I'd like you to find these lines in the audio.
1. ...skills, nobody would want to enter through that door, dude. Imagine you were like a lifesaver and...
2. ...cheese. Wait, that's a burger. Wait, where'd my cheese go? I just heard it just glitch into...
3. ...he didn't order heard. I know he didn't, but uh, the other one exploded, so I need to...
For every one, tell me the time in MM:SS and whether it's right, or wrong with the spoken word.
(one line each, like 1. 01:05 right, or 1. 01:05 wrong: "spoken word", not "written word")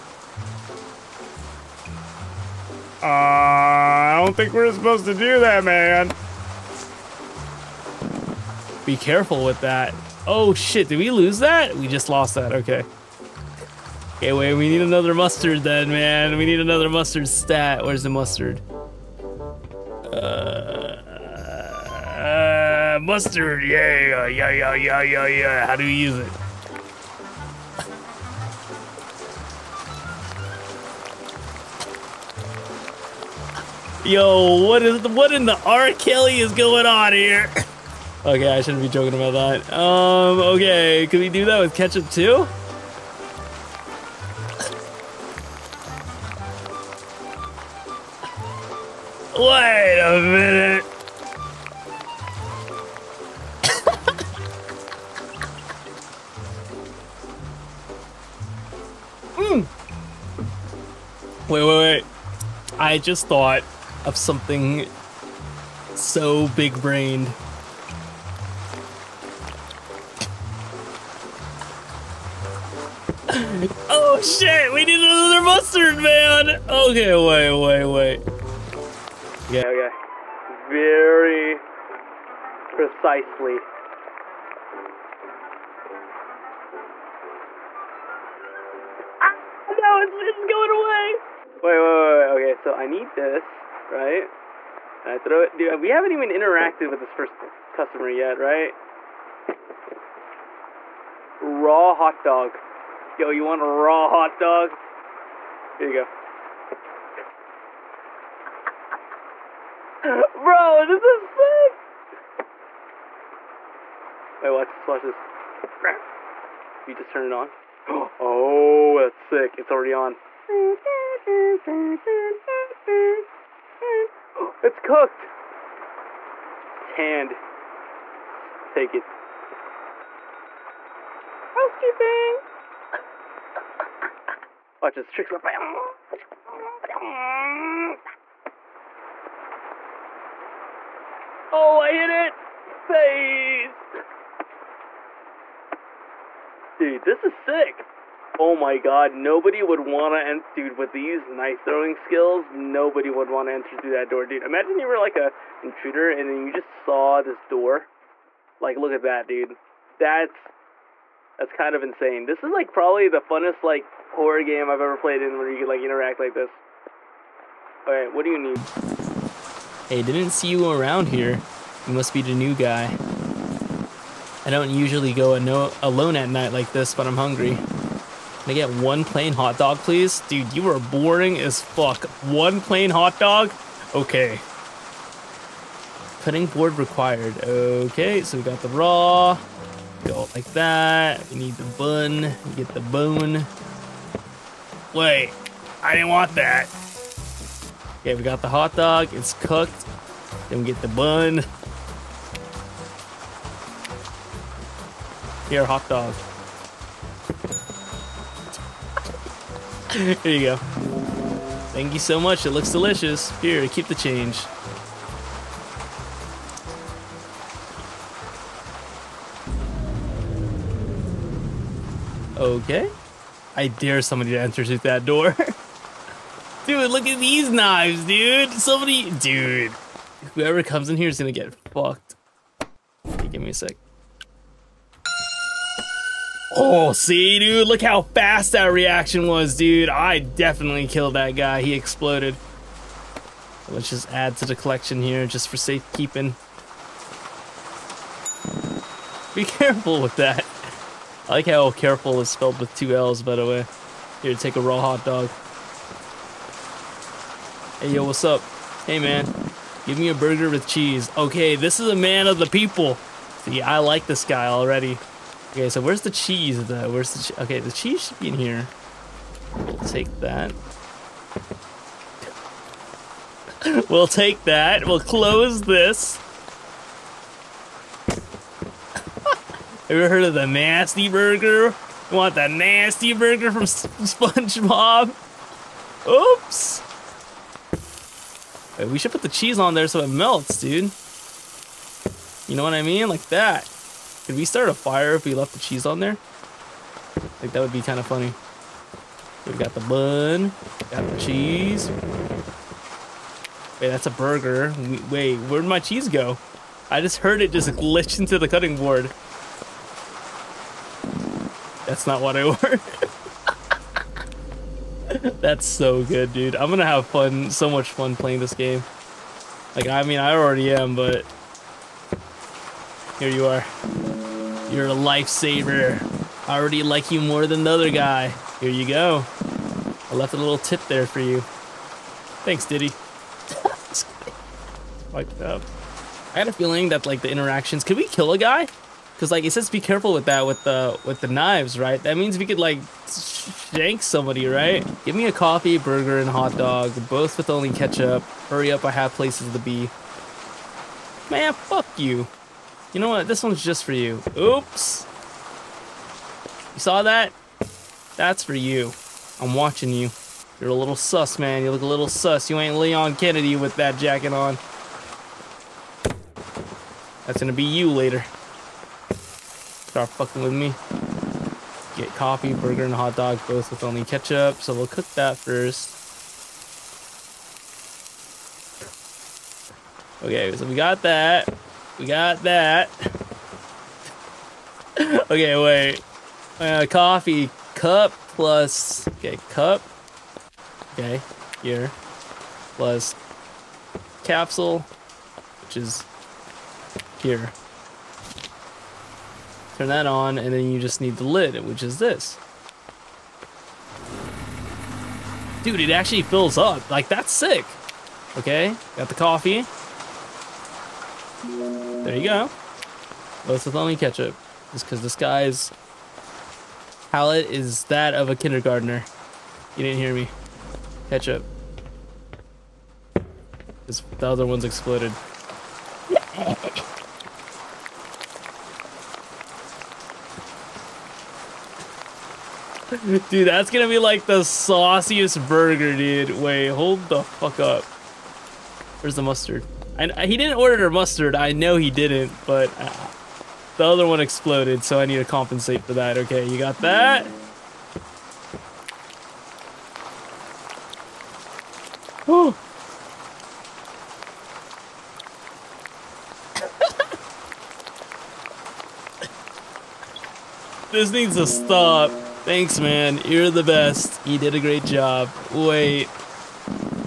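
1. 02:31 wrong: "intruder", not "lifesaver"
2. 05:01 right
3. 07:20 wrong: "mustard", not "heard".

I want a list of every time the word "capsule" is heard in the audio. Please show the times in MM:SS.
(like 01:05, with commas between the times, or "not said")
06:34.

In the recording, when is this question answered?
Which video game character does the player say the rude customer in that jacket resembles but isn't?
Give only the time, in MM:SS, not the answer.
06:02.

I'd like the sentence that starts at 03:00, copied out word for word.
Dude, you are boring as fuck.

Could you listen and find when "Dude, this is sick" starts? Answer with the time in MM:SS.
02:26.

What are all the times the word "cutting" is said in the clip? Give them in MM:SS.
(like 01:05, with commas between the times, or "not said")
03:06, 05:08.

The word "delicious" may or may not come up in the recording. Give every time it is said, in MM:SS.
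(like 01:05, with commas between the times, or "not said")
03:32.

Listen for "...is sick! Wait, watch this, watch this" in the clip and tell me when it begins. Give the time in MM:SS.
01:51.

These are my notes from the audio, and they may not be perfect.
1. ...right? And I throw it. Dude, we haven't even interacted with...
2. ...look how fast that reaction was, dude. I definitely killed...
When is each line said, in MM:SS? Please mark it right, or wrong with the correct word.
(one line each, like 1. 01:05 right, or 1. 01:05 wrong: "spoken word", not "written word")
1. 01:33 right
2. 03:57 right.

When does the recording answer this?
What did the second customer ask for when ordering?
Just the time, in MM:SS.
04:20.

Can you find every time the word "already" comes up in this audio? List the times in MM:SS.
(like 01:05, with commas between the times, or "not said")
01:59, 04:24, 05:20, 05:26.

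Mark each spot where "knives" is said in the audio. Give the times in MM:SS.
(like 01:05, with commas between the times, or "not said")
03:47, 05:41.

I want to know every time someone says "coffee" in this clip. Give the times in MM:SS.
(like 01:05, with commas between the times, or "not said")
05:45, 06:12, 06:26, 06:49.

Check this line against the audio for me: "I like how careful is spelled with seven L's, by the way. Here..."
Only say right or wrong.
wrong.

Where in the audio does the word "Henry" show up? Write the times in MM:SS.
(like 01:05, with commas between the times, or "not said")
not said.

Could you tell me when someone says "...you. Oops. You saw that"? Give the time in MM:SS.
05:53.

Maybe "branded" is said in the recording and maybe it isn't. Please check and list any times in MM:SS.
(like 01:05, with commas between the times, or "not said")
not said.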